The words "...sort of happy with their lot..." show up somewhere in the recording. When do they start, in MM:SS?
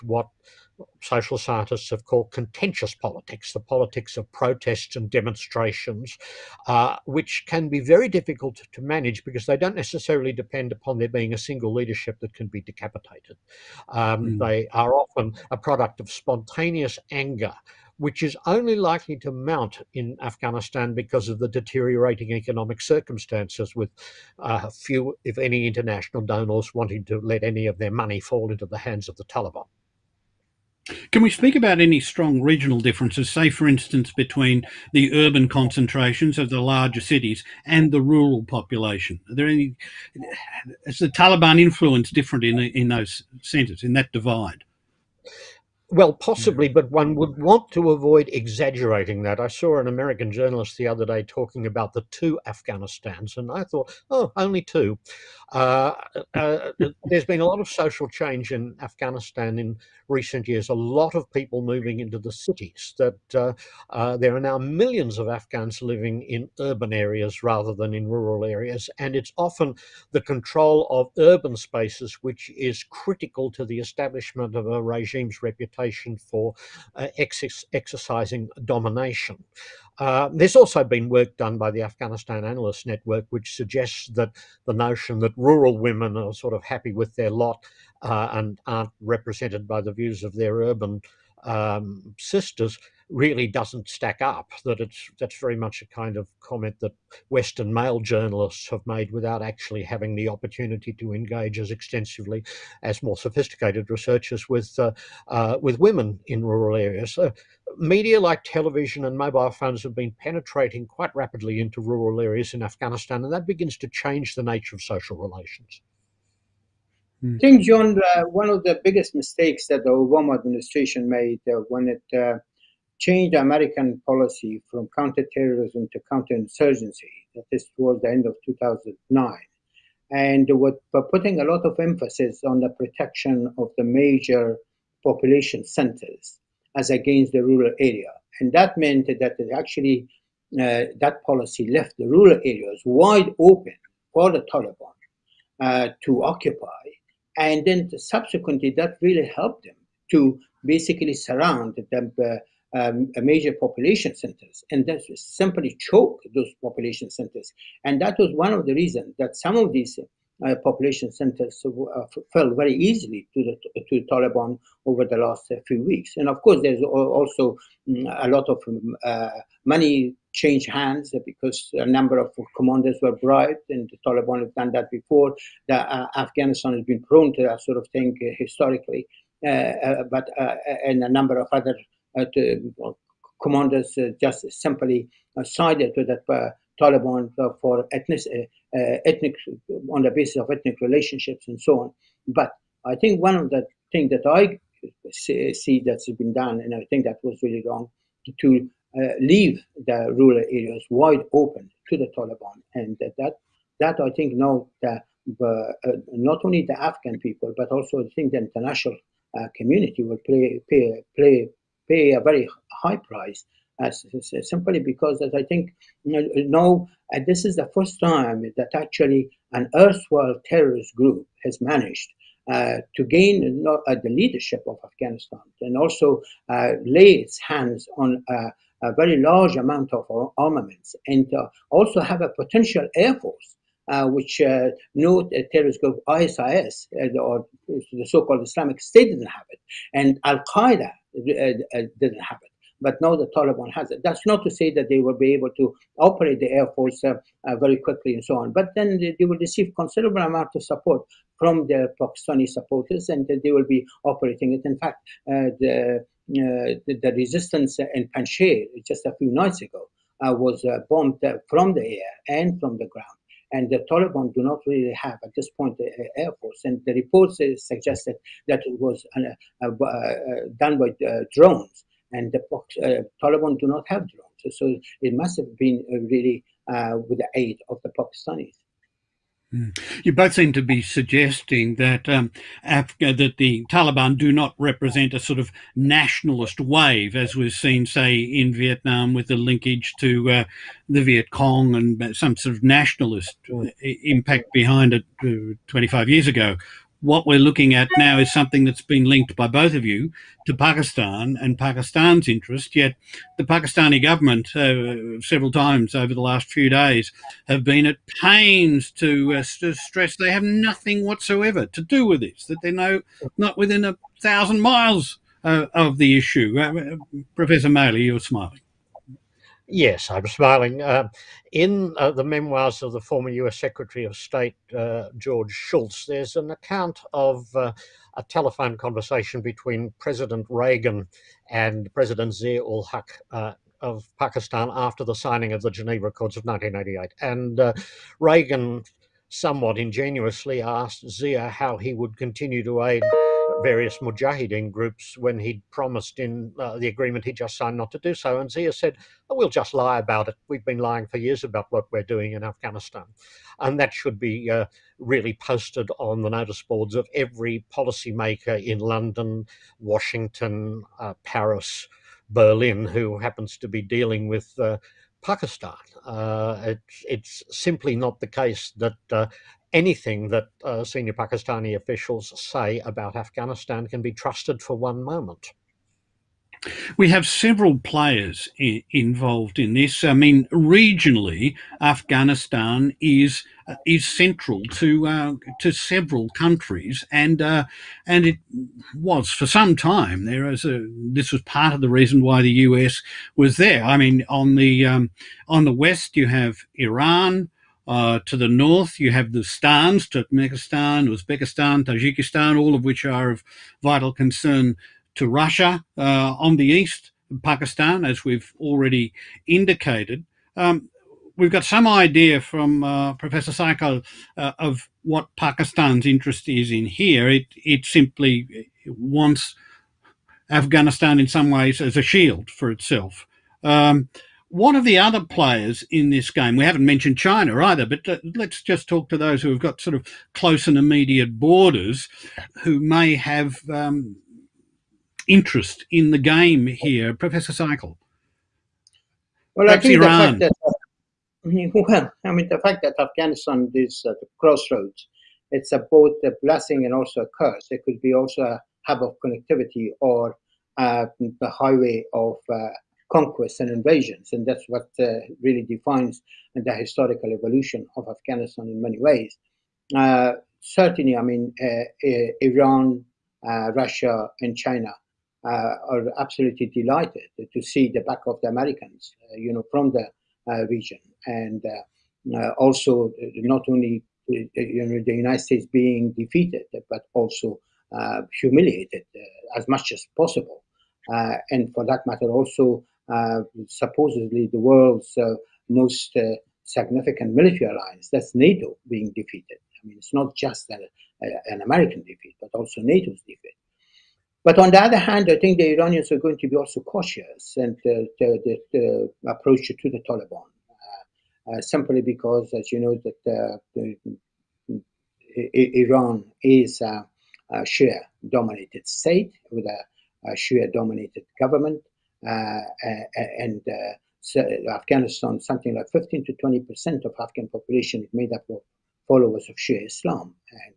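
01:26.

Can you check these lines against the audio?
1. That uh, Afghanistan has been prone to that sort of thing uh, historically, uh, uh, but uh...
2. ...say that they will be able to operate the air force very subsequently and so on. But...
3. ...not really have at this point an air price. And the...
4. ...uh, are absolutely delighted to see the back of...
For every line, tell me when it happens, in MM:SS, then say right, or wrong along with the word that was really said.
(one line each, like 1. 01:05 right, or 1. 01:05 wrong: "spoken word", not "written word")
1. 02:55 right
2. 04:04 wrong: "quickly", not "subsequently"
3. 04:24 wrong: "force", not "price"
4. 07:45 right.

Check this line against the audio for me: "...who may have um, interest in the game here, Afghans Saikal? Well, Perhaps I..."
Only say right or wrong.
wrong.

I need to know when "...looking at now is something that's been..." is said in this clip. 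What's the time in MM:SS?
04:57.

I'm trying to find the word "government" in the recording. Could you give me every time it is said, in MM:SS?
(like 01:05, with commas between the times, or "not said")
05:04, 08:31.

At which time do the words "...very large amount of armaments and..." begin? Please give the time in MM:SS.
03:48.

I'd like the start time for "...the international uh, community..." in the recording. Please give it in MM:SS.
03:28.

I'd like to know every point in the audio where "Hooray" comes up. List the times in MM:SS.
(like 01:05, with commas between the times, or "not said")
not said.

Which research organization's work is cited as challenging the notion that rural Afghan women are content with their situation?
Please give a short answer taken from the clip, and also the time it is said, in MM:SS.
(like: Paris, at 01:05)
Afghanistan Analyst Network, at 01:21.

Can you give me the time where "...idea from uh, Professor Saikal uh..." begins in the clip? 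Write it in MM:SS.
06:51.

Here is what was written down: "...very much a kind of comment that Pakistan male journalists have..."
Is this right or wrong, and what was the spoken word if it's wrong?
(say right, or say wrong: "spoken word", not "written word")
wrong: "Western", not "Pakistan".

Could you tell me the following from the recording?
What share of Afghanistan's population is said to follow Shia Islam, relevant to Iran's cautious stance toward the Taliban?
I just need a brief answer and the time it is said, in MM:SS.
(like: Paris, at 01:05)
15 to 20 percent, at 08:35.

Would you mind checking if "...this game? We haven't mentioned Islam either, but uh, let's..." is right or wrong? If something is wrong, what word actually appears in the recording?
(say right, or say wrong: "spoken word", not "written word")
wrong: "China", not "Islam".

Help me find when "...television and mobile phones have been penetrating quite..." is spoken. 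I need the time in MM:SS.
01:48.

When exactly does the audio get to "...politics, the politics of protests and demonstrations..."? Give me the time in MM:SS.
00:02.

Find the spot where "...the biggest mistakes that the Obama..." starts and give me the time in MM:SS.
01:58.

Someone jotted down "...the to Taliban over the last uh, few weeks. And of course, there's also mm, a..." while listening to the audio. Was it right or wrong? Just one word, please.
right.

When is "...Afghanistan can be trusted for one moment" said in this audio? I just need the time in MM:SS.
06:13.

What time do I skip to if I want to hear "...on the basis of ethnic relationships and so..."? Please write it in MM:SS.
03:09.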